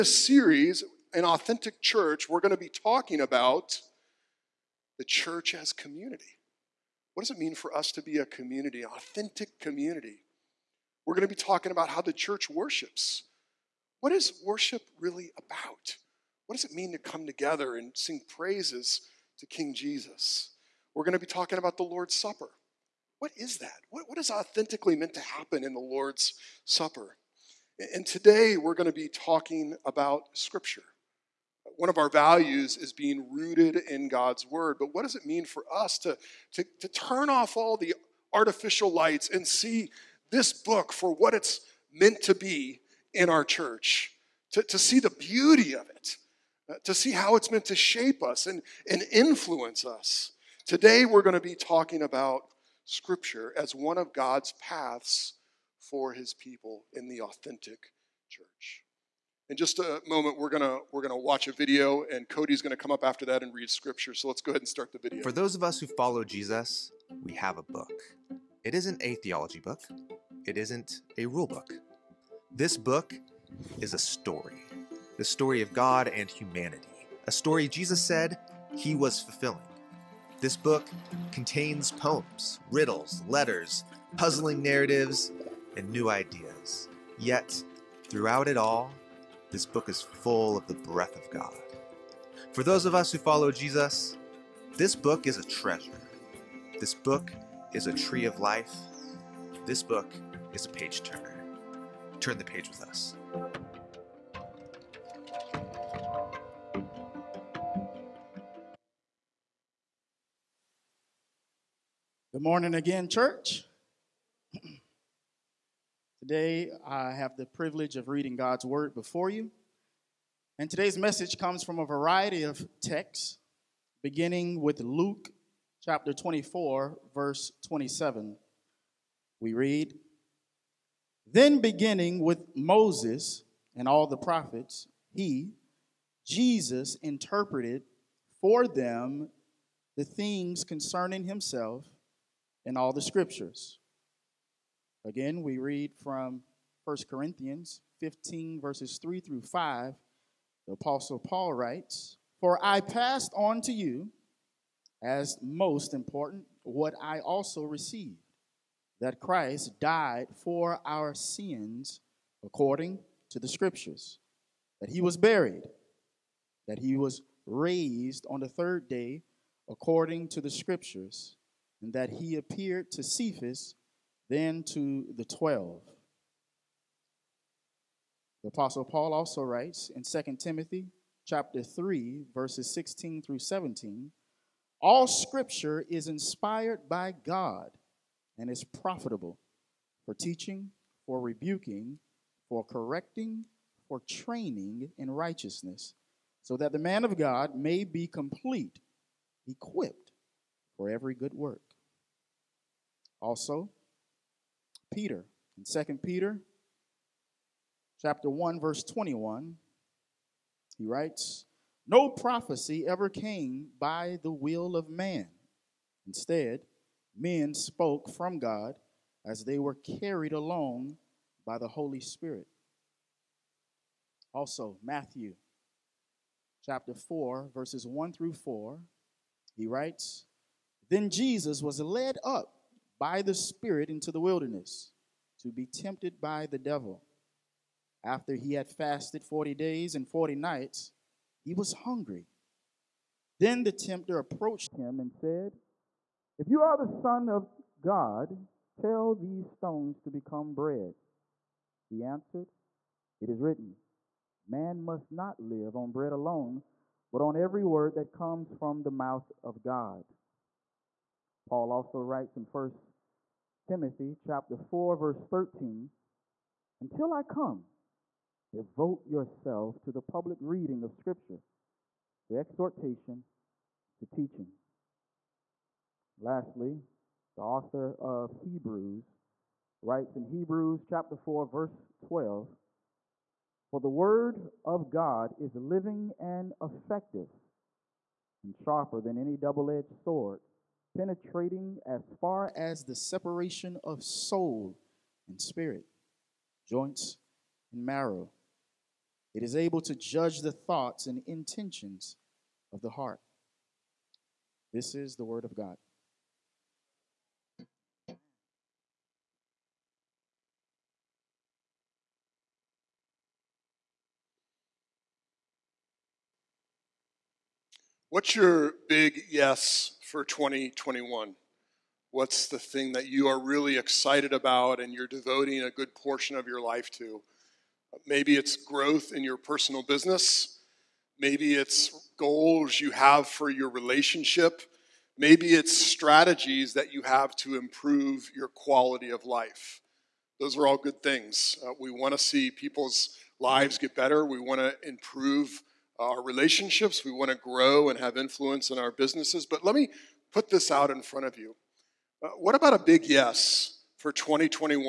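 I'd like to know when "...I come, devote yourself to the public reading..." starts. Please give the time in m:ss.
4:27.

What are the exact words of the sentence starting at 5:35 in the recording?
Maybe it's strategies that you have to improve your quality of life.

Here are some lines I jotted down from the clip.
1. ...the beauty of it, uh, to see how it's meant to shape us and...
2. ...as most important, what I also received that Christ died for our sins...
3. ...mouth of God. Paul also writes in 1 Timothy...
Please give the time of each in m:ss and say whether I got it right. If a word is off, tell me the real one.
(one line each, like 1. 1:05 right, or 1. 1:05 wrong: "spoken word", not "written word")
1. 0:44 right
2. 2:35 right
3. 4:18 right.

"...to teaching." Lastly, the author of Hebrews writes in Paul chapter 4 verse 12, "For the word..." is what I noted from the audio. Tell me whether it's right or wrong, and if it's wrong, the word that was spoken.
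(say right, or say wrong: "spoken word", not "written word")
wrong: "Hebrews", not "Paul".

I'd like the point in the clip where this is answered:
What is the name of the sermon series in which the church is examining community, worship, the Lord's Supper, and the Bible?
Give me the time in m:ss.
0:01.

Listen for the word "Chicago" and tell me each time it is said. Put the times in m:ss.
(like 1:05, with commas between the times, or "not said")
not said.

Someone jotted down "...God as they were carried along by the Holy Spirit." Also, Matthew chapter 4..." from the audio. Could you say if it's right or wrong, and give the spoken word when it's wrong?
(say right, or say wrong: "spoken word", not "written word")
right.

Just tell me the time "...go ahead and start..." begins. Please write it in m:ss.
1:04.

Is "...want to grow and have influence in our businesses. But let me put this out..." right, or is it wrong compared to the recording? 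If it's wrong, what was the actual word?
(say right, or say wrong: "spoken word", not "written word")
right.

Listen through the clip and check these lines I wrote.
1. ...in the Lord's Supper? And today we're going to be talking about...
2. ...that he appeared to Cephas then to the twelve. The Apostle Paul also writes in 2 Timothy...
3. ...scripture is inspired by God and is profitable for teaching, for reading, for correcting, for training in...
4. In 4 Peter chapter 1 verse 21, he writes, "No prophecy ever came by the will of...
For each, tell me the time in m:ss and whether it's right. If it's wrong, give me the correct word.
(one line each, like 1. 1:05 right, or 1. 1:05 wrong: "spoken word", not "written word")
1. 0:25 right
2. 2:51 right
3. 3:05 wrong: "rebuking", not "reading"
4. 3:25 wrong: "2", not "4".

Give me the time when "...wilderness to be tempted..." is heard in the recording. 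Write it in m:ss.
3:54.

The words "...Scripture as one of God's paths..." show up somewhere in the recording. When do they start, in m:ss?
0:52.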